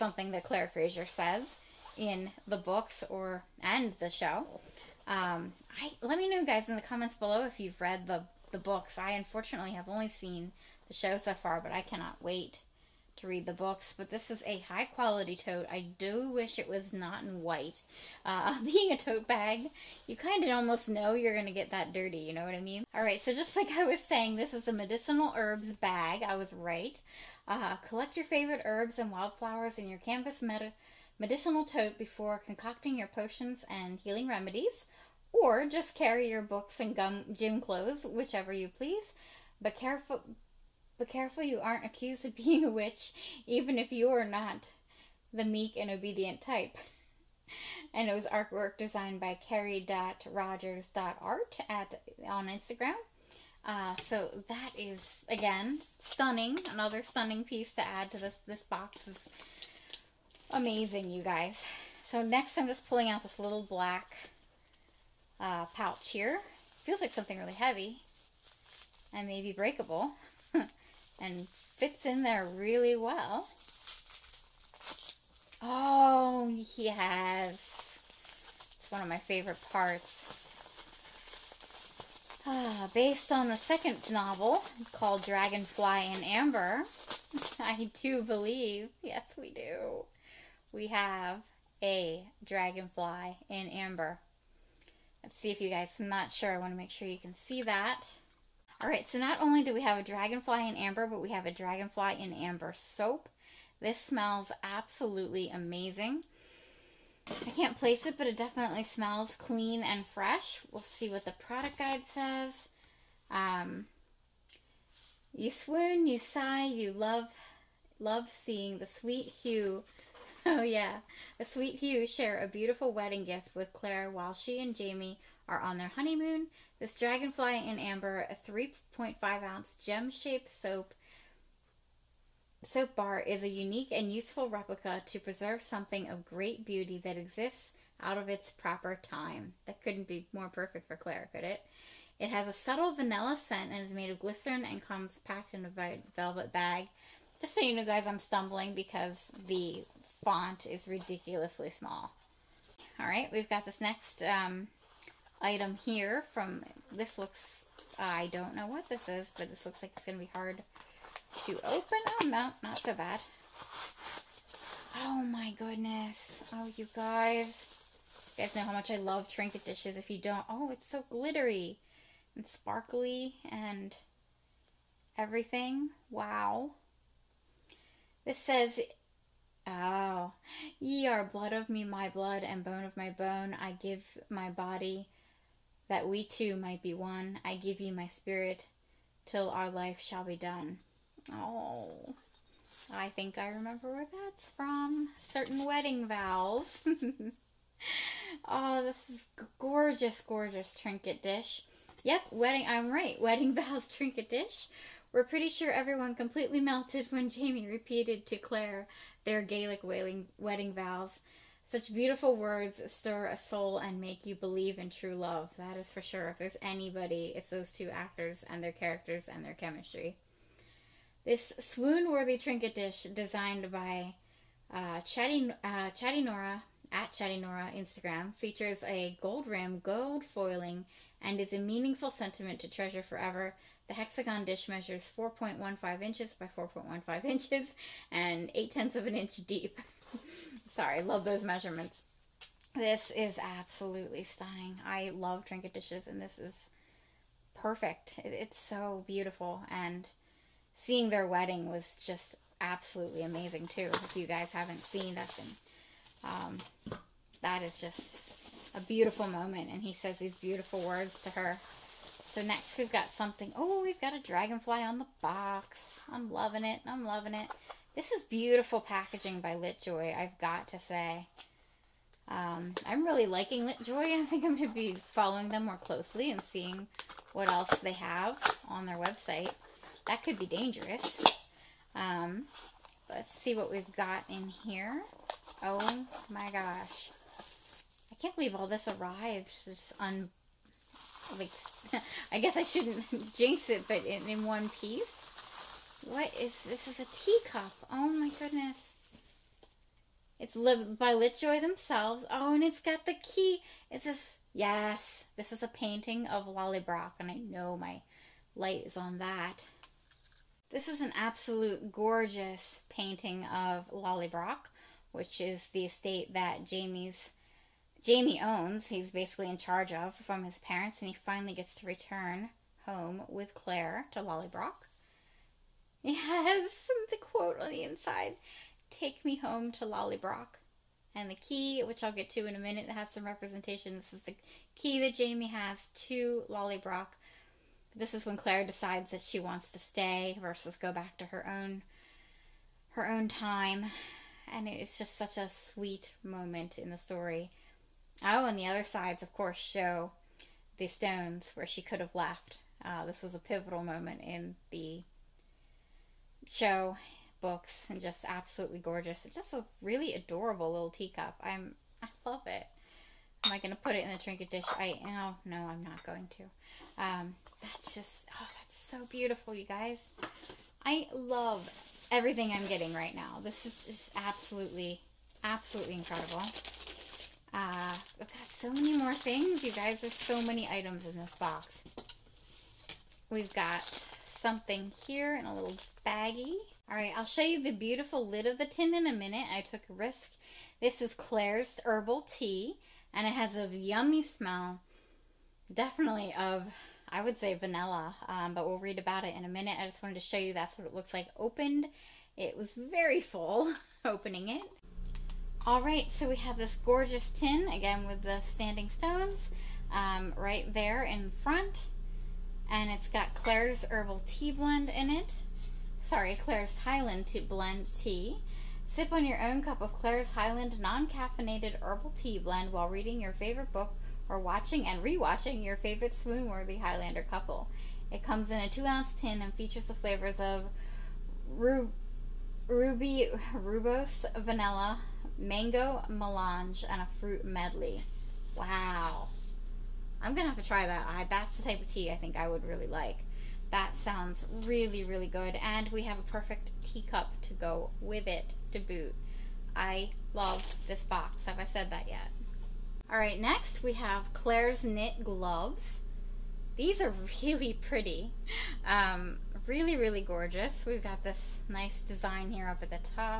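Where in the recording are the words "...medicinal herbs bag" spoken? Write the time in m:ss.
0:24.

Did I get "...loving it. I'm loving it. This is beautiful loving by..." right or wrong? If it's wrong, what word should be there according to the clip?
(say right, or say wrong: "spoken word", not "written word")
wrong: "packaging", not "loving".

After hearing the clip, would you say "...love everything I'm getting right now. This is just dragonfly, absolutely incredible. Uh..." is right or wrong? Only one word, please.
wrong.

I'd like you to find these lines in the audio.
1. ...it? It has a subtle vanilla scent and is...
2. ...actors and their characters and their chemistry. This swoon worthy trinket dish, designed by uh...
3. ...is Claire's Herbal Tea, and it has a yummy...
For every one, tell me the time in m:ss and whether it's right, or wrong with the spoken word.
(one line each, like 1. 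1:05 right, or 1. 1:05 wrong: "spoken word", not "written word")
1. 2:21 right
2. 3:37 right
3. 6:31 right.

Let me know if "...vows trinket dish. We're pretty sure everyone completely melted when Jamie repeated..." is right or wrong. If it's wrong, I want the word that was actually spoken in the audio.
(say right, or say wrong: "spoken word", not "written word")
right.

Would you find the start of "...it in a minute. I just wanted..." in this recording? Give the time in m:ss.
6:39.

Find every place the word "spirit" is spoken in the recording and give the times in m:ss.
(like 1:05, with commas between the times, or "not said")
3:08.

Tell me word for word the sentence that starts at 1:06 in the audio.
Feels like something really heavy and maybe breakable.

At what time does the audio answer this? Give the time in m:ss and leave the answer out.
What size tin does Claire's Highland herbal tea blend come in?
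7:08.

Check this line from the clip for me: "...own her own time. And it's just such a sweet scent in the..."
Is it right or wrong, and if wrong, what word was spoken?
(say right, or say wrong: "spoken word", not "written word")
wrong: "moment", not "scent".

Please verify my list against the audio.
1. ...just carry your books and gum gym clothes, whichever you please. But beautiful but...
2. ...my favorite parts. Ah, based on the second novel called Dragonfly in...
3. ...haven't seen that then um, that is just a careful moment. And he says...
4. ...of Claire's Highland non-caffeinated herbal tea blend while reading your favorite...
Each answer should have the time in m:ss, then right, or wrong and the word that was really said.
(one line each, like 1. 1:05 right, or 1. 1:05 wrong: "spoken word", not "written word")
1. 0:35 wrong: "careful", not "beautiful"
2. 1:19 right
3. 4:14 wrong: "beautiful", not "careful"
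4. 6:59 right.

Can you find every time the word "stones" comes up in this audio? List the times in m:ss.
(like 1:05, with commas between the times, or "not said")
5:50, 6:48.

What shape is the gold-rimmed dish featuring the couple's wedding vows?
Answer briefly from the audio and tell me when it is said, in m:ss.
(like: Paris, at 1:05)
Hexagon, at 3:53.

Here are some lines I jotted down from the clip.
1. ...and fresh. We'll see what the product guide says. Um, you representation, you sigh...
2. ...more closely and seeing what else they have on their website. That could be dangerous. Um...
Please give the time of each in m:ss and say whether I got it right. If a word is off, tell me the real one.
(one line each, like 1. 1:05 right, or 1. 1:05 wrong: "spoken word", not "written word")
1. 1:49 wrong: "swoon", not "representation"
2. 4:35 right.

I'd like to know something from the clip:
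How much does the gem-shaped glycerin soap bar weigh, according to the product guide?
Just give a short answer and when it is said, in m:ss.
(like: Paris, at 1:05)
3.5 ounces, at 2:08.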